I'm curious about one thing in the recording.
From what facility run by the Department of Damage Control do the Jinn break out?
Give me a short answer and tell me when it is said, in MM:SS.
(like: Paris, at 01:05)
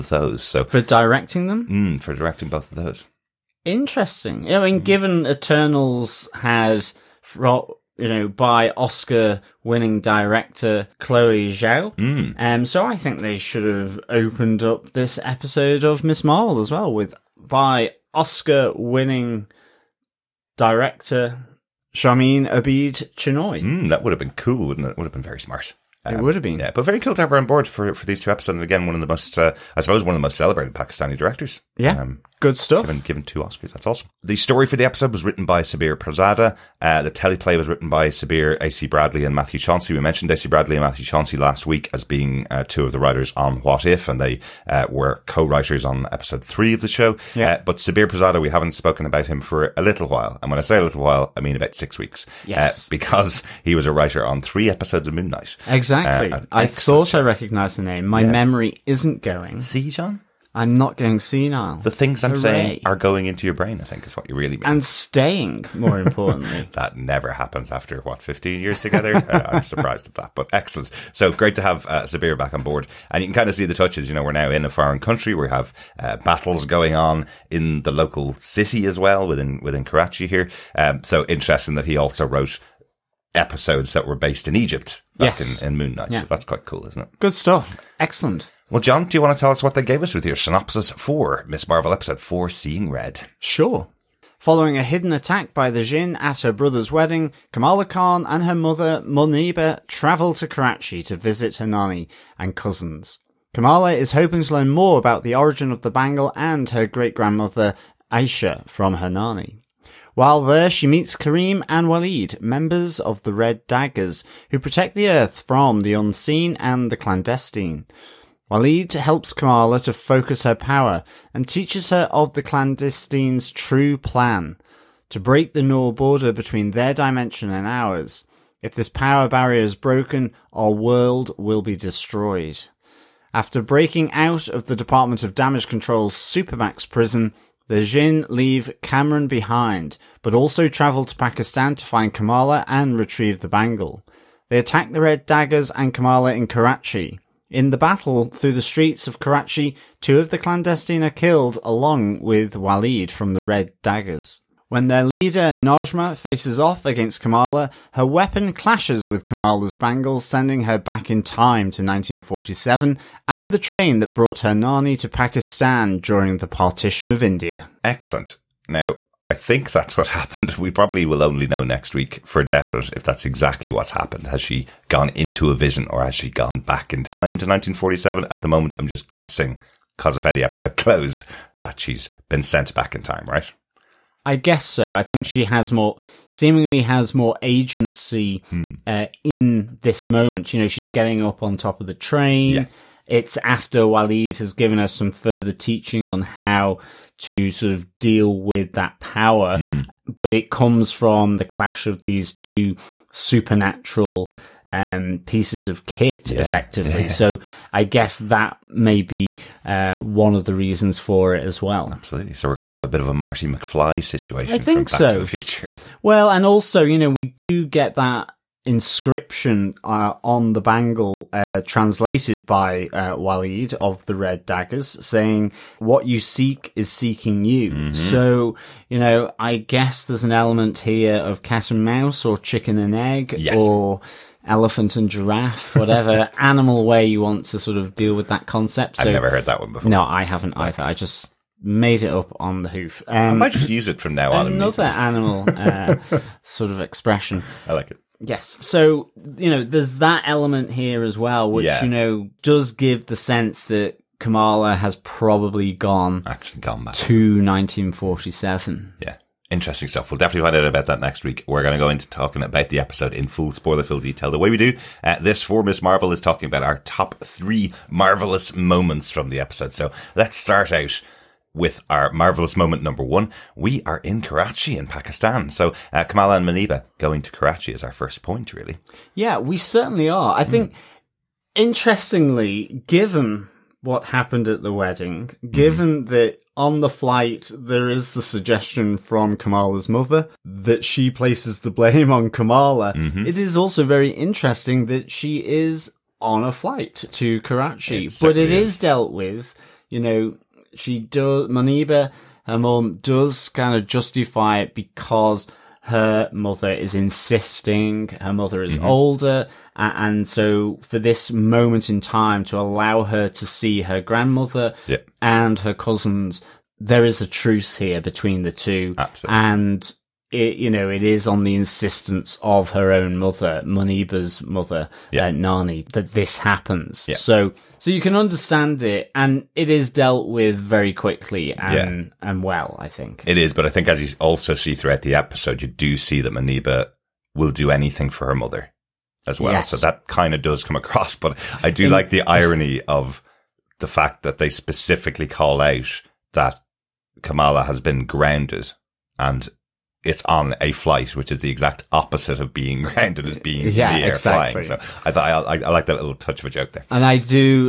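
Supermax prison, at 02:16.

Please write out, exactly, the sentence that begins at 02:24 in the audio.
They attack the Red Daggers and Kamala in Karachi.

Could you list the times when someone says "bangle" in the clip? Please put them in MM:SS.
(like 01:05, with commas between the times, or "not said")
01:45, 02:23, 02:39, 03:40.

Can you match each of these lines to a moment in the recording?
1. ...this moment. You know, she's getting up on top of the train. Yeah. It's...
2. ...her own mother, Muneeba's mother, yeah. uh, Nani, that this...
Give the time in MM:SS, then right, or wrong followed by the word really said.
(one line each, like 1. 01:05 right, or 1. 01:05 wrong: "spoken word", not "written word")
1. 03:09 right
2. 05:22 right.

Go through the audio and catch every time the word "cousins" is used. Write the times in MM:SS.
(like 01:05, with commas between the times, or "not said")
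01:42, 05:15.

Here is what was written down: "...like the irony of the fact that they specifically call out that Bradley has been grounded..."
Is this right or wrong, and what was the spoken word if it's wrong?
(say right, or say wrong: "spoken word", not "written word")
wrong: "Kamala", not "Bradley".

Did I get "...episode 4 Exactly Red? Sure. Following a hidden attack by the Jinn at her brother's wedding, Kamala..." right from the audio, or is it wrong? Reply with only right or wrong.
wrong.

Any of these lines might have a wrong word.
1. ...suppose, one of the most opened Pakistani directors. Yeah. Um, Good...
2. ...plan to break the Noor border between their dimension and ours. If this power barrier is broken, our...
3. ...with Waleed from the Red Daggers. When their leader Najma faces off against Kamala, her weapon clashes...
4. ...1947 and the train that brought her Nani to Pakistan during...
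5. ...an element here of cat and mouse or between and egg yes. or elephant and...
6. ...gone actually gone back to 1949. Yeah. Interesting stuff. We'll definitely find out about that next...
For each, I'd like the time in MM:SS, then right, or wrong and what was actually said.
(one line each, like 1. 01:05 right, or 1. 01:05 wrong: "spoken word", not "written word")
1. 00:29 wrong: "celebrated", not "opened"
2. 02:03 right
3. 02:32 right
4. 02:41 right
5. 03:50 wrong: "chicken", not "between"
6. 04:15 wrong: "1947", not "1949".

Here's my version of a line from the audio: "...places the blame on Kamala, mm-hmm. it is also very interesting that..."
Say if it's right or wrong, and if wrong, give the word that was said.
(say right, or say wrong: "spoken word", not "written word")
right.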